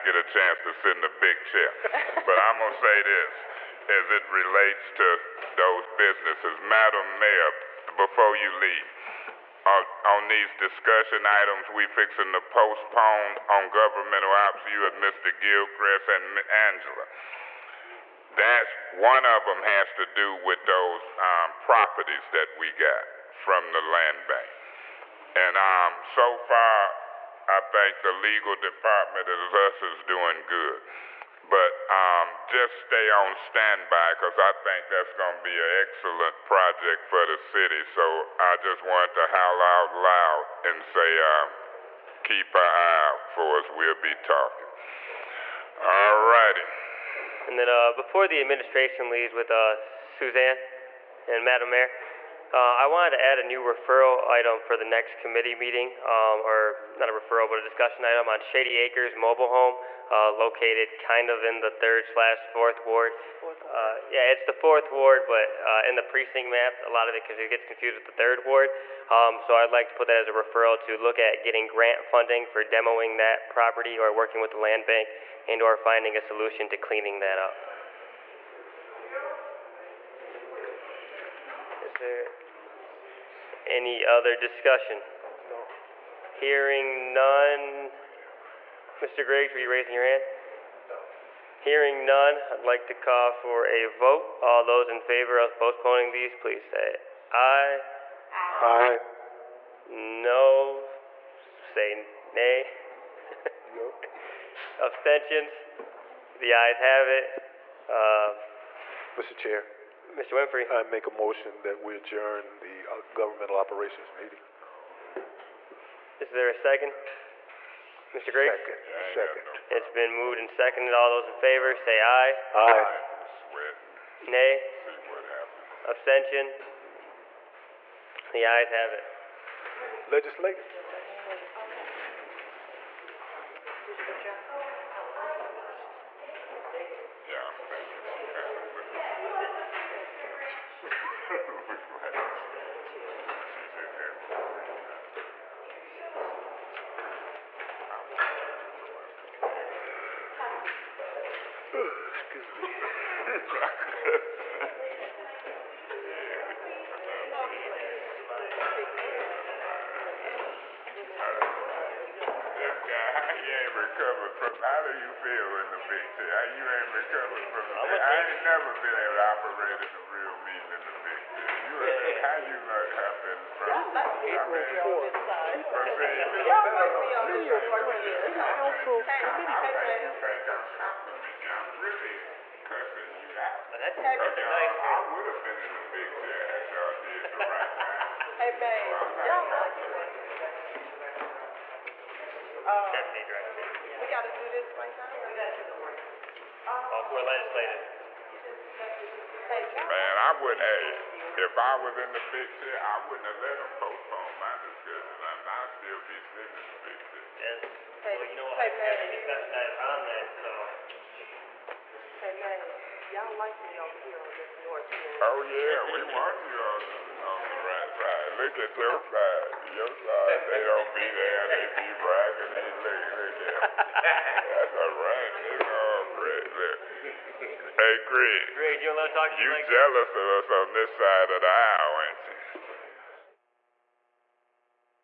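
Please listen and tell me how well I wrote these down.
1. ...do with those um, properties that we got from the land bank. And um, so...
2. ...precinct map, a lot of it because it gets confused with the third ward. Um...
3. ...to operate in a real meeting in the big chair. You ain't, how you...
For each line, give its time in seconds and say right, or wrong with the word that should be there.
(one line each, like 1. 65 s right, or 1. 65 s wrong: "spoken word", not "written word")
1. 20 s right
2. 66 s right
3. 169 s right.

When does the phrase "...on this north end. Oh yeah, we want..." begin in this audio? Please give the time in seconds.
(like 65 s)
214 s.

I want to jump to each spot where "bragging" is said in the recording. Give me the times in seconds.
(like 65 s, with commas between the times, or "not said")
222 s.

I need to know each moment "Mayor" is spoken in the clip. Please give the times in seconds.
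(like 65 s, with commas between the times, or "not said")
7 s, 51 s.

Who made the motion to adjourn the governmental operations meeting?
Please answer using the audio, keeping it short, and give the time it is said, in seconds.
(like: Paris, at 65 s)
Mr. Winfrey, at 110 s.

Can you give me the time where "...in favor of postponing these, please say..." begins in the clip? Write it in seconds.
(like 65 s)
94 s.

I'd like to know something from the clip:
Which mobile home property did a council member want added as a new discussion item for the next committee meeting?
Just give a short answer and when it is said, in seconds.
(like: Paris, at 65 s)
Shady Acres Mobile Home, at 58 s.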